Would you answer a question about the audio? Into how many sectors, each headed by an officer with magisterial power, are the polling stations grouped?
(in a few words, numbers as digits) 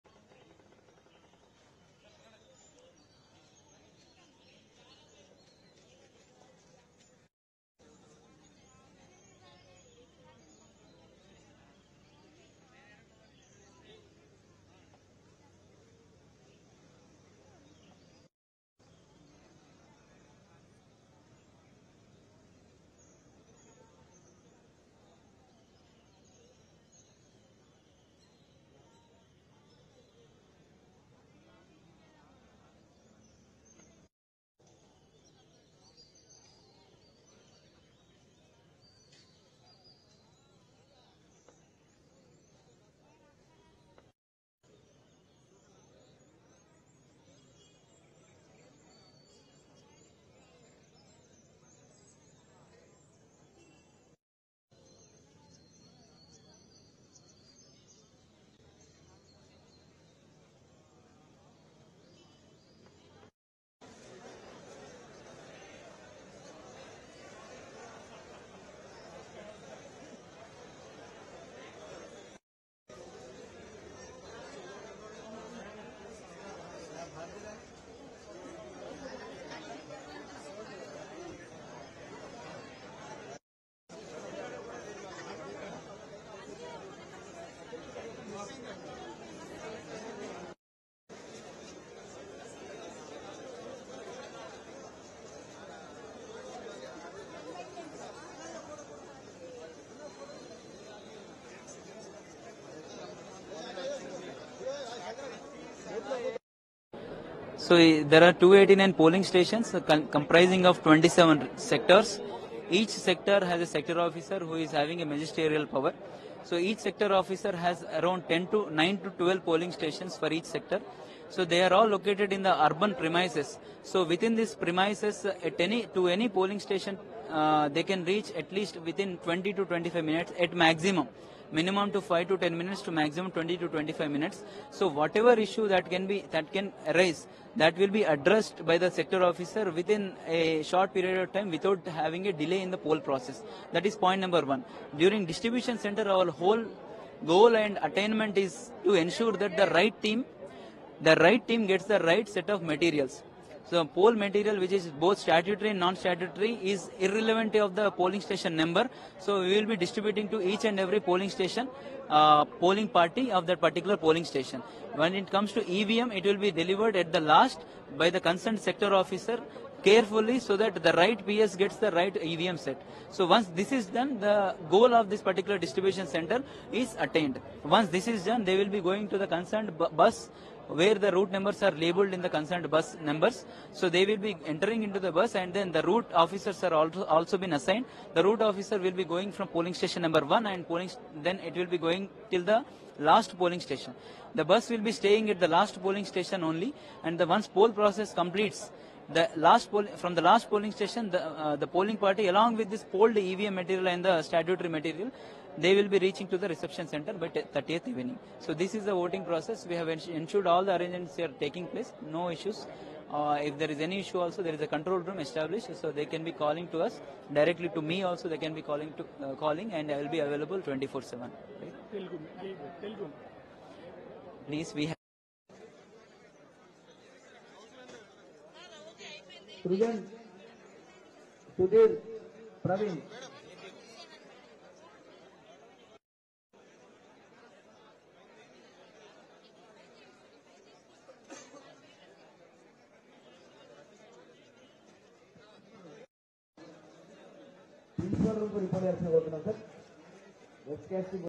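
27.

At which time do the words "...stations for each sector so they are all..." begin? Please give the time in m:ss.
1:59.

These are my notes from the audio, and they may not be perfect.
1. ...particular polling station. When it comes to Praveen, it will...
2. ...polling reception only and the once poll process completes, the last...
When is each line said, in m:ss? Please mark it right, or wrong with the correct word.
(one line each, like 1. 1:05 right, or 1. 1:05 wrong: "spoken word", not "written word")
1. 2:43 wrong: "EVM", not "Praveen"
2. 3:15 wrong: "station", not "reception".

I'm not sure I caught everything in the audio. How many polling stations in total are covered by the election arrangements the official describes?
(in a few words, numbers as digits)
289.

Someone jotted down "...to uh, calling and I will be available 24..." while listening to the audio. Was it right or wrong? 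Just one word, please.
right.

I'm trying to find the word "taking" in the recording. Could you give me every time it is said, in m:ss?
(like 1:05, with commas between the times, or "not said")
3:31.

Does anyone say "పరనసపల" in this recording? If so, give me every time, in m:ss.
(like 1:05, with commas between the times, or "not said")
4:08.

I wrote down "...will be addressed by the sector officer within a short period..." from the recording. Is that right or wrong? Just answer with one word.
right.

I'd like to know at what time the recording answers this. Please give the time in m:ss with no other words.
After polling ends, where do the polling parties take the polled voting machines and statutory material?
3:26.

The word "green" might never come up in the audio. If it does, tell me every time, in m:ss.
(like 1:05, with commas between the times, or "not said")
not said.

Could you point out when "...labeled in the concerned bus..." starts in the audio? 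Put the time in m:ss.
3:01.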